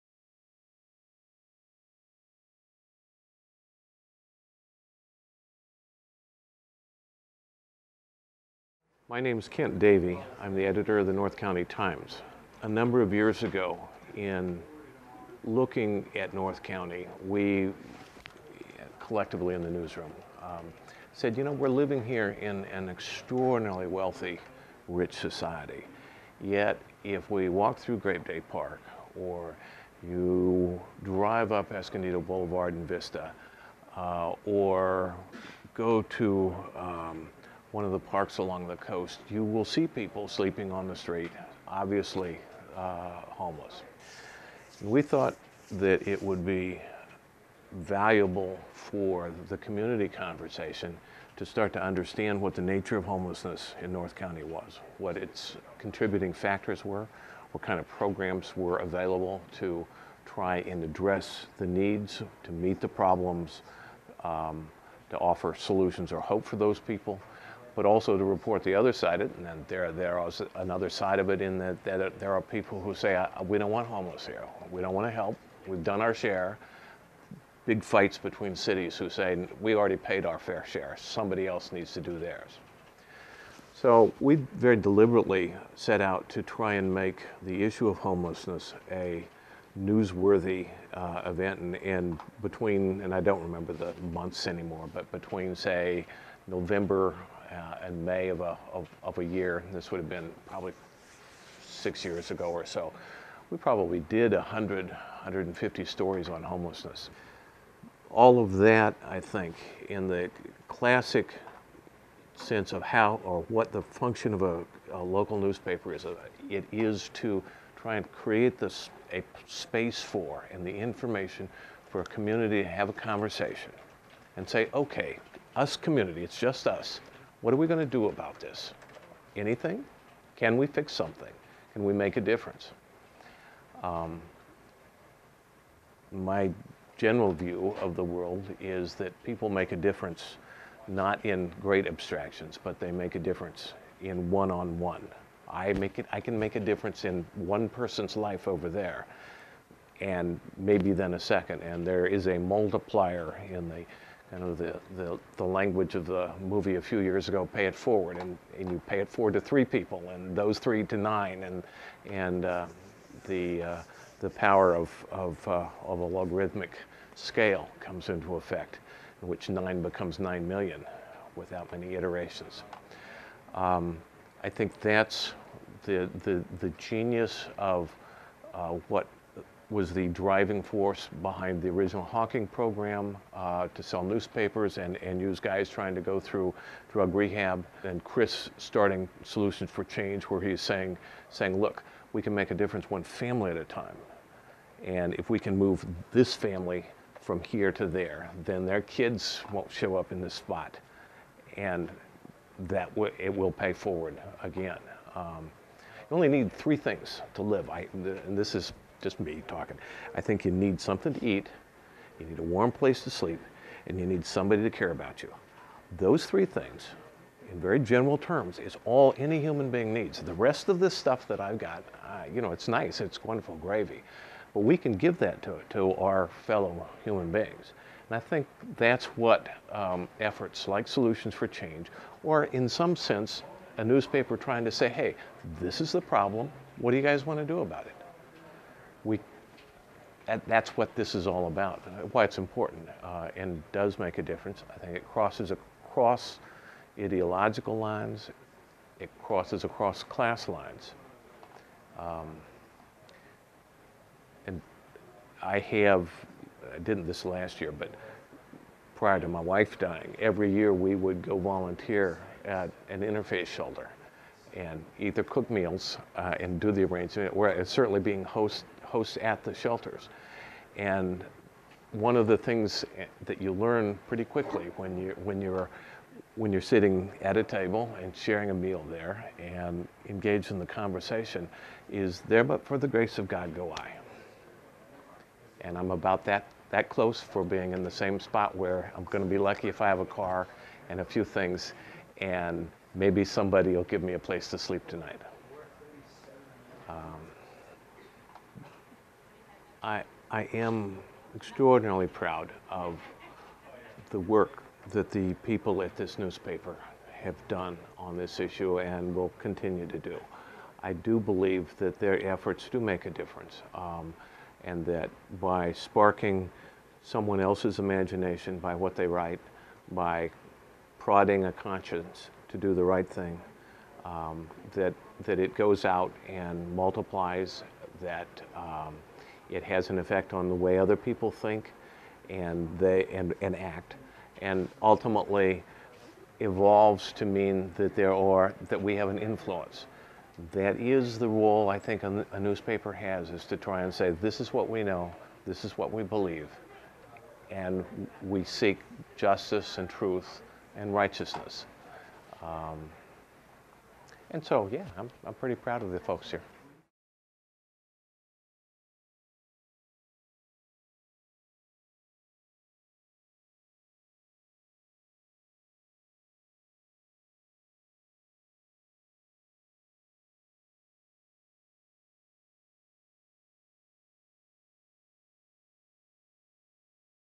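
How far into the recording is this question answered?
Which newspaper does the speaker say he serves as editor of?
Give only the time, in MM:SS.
00:11.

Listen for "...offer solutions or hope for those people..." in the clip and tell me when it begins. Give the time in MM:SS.
01:05.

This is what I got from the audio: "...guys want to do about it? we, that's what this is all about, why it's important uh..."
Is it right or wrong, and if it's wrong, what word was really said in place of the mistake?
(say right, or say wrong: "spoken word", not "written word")
right.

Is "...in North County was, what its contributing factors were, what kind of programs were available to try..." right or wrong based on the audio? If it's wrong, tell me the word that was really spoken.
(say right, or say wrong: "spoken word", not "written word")
right.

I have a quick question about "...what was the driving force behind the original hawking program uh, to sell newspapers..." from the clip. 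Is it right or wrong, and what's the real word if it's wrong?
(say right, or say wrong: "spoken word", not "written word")
right.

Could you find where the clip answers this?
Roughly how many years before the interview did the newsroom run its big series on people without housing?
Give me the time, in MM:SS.
01:41.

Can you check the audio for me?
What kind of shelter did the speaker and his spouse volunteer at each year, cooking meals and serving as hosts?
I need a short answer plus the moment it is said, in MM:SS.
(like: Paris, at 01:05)
interfaith shelter, at 04:23.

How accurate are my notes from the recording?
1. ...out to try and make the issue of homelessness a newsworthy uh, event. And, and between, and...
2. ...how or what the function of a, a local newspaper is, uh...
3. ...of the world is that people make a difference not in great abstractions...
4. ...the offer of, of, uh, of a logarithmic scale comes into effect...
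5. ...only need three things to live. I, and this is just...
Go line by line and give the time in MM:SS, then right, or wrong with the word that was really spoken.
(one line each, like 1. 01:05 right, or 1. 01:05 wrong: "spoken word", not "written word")
1. 01:26 right
2. 01:52 right
3. 02:17 right
4. 02:44 wrong: "power", not "offer"
5. 03:26 right.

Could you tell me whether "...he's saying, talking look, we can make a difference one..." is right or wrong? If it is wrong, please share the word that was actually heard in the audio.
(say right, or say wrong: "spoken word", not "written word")
wrong: "saying", not "talking".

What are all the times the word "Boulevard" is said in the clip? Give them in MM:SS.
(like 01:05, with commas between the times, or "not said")
00:32.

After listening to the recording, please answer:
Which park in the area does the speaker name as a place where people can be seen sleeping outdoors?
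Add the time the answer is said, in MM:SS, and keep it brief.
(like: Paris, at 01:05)
Grape Day Park, at 00:27.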